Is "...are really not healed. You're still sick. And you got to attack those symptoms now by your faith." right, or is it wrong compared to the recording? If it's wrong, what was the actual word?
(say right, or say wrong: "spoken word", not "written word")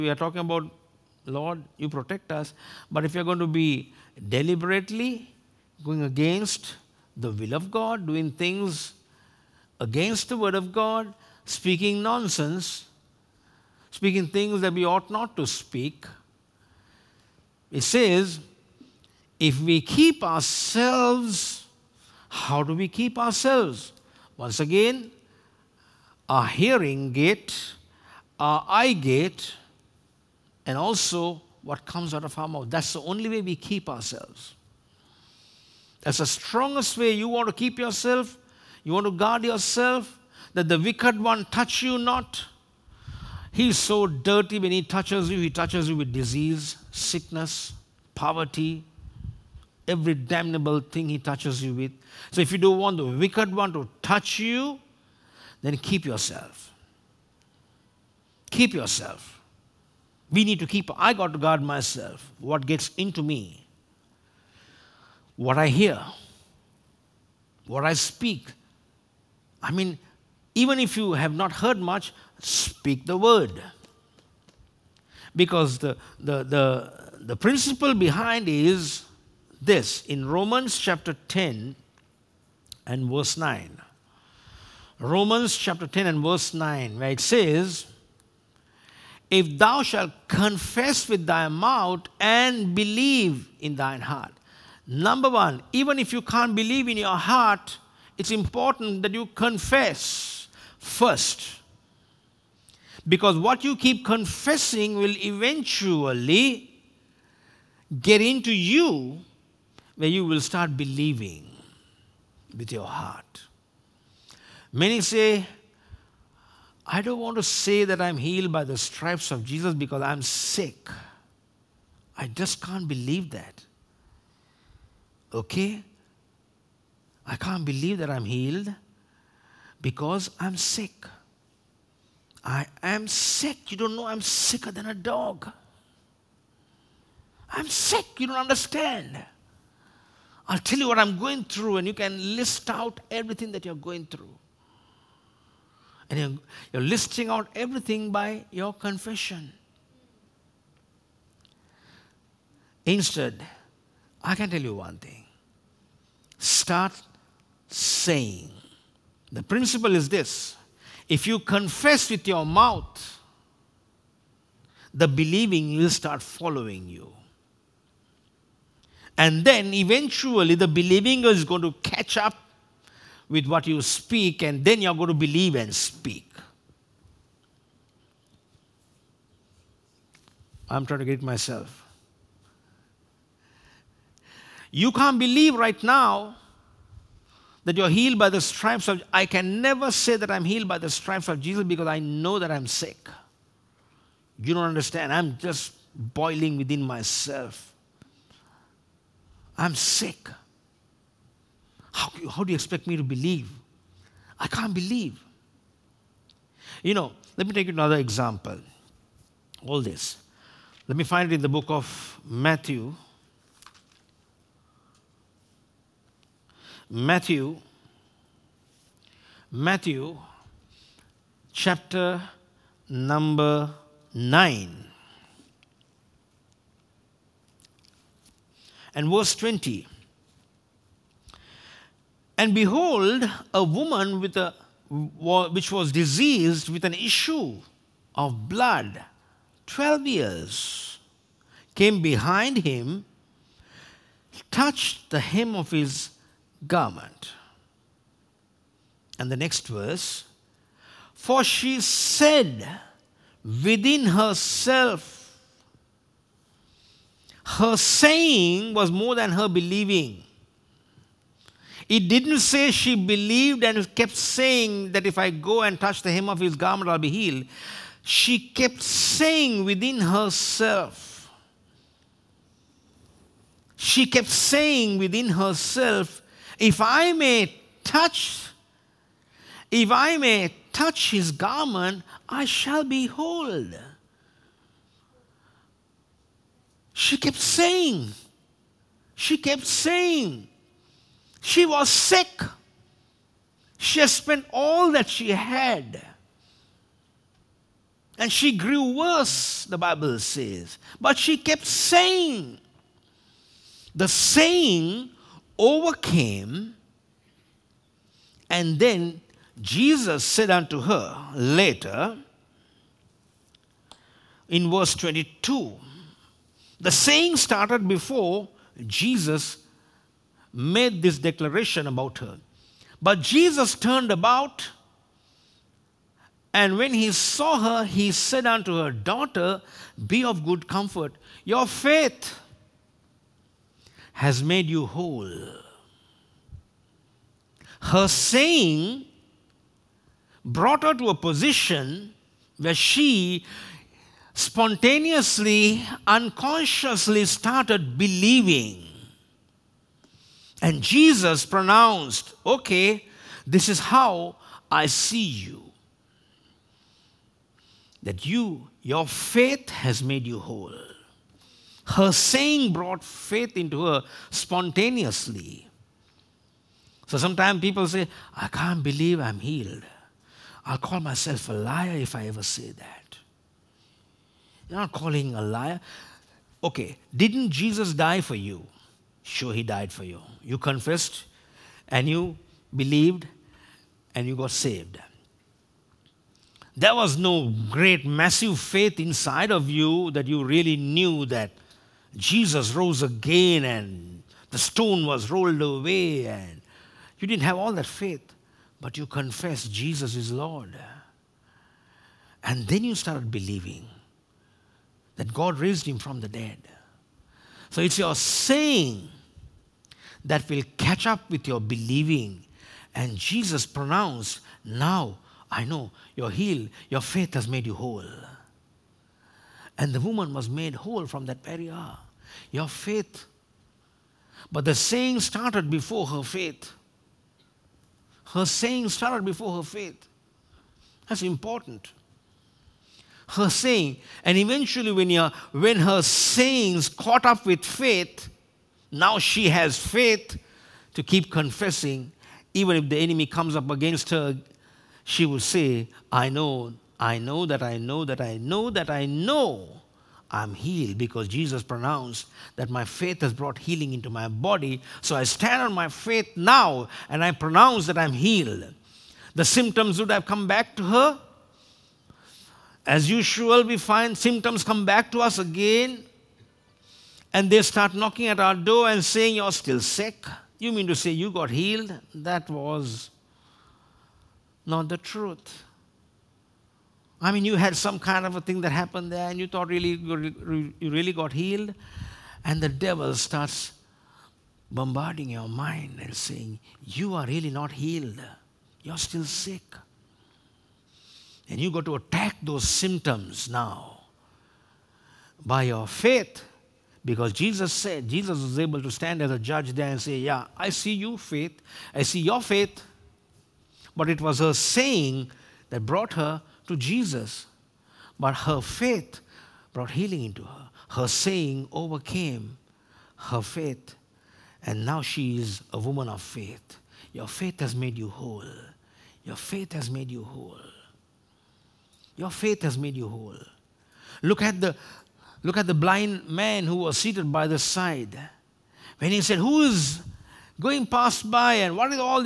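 right.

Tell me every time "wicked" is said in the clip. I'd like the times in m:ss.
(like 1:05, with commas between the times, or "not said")
0:40, 0:53.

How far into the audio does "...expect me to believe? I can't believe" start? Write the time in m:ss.
3:22.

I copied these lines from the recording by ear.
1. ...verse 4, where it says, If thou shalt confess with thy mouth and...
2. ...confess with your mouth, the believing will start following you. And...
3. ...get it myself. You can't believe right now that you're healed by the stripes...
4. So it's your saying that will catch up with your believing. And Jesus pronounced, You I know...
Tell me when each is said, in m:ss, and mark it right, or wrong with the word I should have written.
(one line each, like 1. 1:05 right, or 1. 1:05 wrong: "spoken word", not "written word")
1. 1:26 wrong: "9", not "4"
2. 2:41 right
3. 3:01 right
4. 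6:47 wrong: "Now", not "You".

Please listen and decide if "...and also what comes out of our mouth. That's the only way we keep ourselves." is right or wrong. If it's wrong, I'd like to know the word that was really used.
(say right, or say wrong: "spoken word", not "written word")
right.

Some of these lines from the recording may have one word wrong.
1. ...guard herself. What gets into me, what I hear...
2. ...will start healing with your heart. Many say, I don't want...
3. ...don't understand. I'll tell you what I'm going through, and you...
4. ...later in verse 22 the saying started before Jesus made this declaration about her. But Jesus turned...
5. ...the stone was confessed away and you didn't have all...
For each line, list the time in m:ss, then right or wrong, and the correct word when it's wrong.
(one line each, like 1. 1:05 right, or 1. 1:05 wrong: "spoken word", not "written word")
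1. 1:01 wrong: "myself", not "herself"
2. 1:50 wrong: "believing", not "healing"
3. 2:18 right
4. 5:11 right
5. 6:34 wrong: "rolled", not "confessed".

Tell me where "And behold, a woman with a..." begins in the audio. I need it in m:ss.
3:52.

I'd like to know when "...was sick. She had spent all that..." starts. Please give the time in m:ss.
4:51.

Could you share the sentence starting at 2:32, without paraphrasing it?
Instead, I can tell you one thing start saying.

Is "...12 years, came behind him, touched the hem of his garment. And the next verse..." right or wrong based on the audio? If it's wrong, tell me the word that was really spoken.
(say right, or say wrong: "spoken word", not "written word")
right.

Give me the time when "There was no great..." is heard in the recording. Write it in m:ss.
6:26.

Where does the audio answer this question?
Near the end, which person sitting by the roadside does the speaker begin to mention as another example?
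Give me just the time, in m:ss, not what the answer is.
8:45.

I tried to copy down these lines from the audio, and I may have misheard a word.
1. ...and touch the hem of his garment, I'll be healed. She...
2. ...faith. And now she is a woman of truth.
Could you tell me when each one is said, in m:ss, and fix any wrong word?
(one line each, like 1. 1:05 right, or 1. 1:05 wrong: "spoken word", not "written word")
1. 4:25 right
2. 8:33 wrong: "faith", not "truth".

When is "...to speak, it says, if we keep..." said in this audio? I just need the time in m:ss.
0:15.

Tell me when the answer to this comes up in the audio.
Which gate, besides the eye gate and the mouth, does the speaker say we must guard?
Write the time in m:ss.
0:26.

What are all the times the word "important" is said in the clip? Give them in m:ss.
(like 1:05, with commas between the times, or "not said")
1:38, 7:11.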